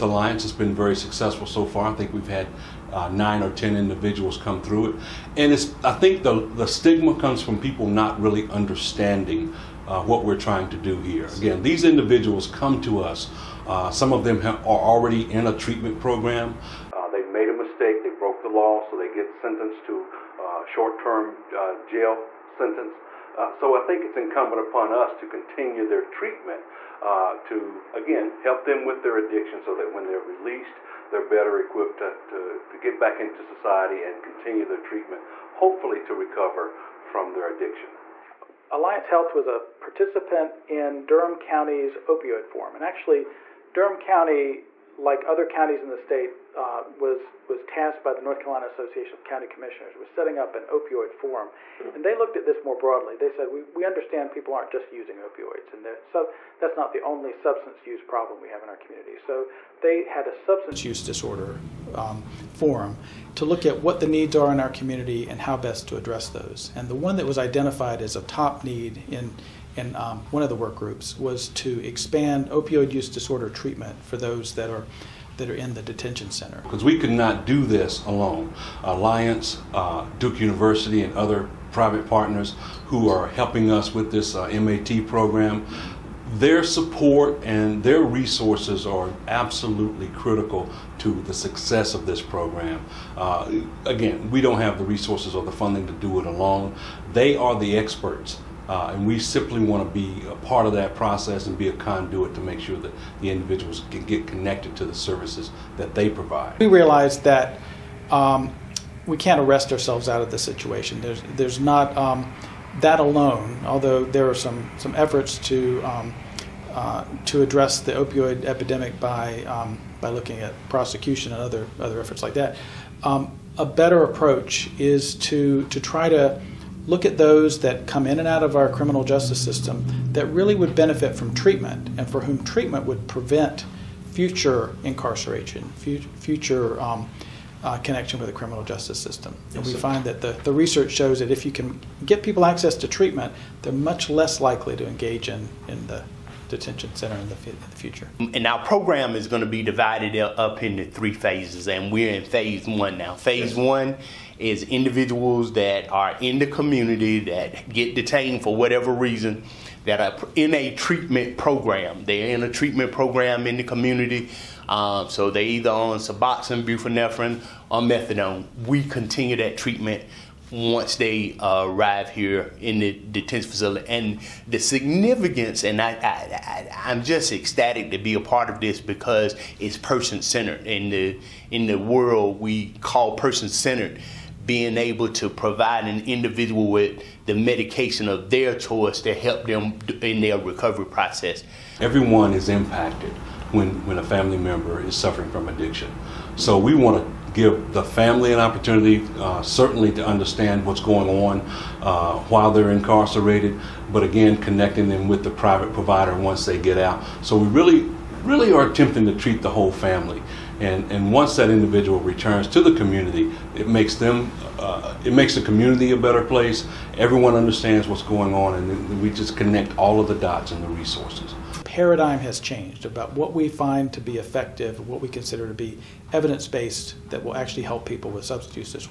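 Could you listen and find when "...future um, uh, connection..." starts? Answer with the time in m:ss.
2:15.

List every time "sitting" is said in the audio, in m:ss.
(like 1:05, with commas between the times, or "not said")
not said.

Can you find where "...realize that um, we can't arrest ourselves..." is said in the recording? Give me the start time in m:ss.
1:46.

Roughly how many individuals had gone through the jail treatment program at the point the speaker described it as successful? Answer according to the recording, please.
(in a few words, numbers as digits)
9 or 10.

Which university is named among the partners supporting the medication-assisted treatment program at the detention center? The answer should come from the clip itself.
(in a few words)
Duke University.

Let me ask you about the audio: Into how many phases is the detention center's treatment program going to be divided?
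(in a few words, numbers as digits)
3.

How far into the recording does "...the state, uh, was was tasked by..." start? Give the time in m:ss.
0:45.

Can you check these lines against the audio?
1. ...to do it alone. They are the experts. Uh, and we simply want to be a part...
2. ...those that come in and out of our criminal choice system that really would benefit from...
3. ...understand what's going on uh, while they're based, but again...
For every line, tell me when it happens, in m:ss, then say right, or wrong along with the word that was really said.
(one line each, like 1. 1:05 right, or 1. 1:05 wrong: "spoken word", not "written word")
1. 1:35 right
2. 2:07 wrong: "justice", not "choice"
3. 3:20 wrong: "incarcerated", not "based".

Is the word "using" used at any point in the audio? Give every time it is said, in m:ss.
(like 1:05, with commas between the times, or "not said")
0:54.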